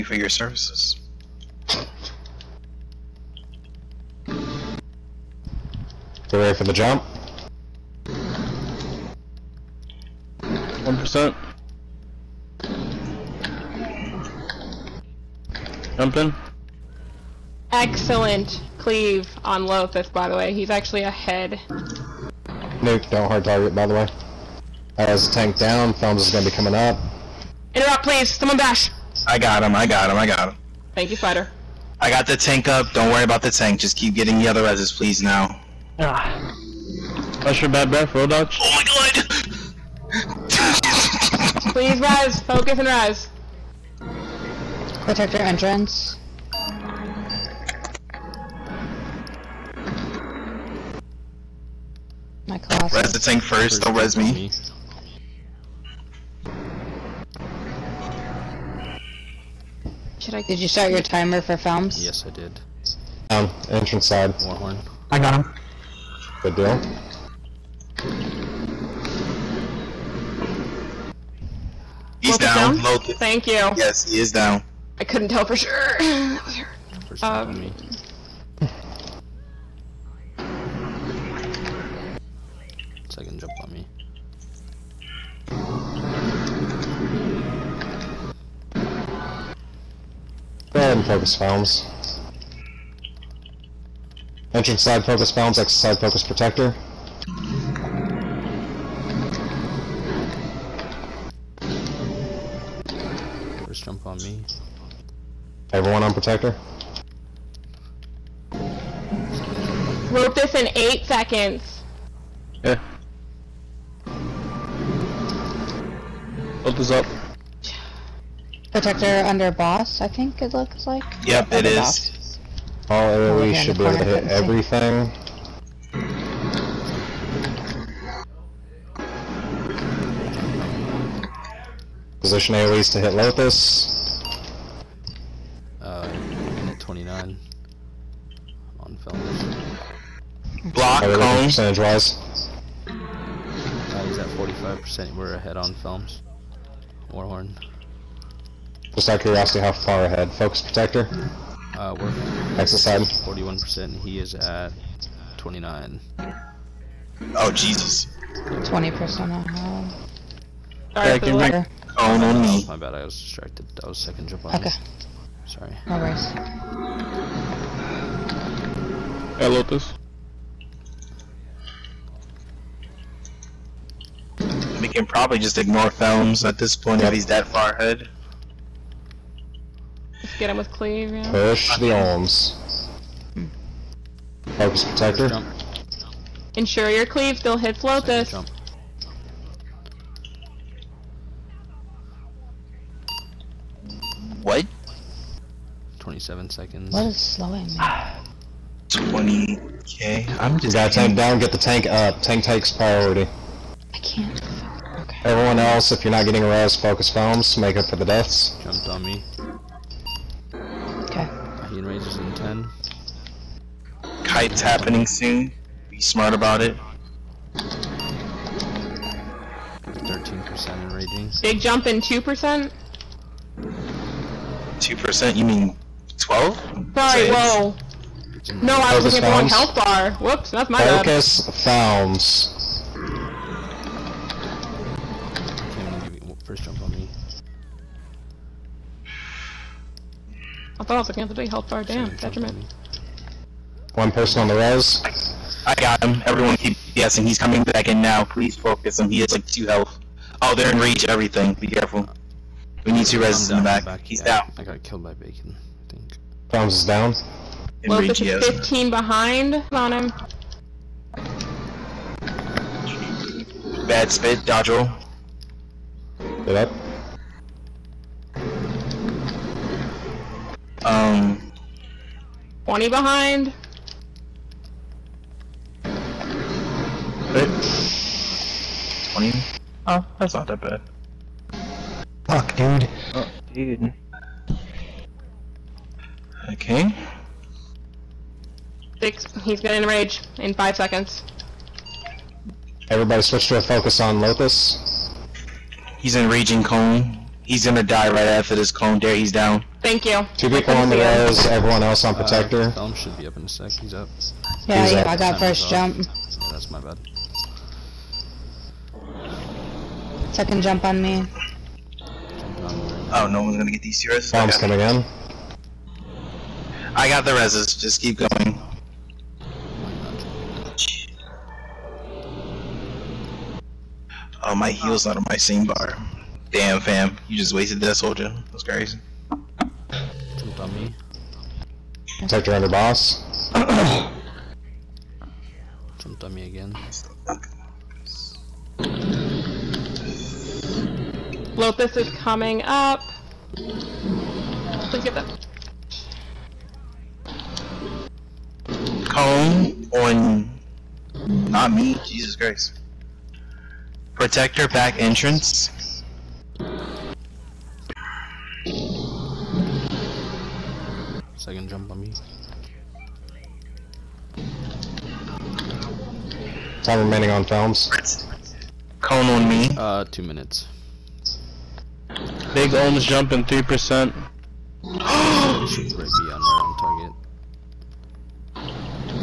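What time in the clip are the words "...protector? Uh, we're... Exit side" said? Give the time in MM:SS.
02:30.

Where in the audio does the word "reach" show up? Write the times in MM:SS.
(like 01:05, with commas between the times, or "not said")
04:10, 04:17.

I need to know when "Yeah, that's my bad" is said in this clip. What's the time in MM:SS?
05:05.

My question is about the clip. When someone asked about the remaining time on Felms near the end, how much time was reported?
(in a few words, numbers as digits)
2 minutes.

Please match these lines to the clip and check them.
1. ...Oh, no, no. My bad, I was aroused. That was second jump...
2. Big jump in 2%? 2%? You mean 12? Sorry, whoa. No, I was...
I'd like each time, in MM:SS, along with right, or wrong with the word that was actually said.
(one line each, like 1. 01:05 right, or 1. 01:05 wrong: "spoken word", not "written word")
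1. 02:41 wrong: "distracted", not "aroused"
2. 03:41 right.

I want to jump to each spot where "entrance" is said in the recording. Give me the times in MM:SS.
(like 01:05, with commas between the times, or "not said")
00:45, 01:03, 01:34, 05:54.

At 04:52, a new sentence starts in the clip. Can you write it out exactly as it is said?
Everybody switch to a focus on Llothis.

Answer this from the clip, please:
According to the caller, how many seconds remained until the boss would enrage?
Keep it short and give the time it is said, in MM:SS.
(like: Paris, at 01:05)
5, at 04:49.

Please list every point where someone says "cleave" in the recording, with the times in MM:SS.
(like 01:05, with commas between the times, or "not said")
00:18, 03:00, 03:07.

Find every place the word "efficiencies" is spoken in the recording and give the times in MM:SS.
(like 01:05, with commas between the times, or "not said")
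not said.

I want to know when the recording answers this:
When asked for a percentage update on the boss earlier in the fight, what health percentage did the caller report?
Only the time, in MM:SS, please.
02:24.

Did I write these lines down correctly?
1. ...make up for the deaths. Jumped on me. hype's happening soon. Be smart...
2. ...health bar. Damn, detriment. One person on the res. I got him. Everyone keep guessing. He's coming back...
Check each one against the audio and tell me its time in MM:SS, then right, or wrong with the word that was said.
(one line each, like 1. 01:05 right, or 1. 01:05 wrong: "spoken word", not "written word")
1. 03:27 right
2. 04:01 right.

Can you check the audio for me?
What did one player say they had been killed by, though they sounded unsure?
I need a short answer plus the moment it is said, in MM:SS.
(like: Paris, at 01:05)
bacon, at 04:15.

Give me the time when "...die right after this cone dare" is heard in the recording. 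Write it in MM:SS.
04:57.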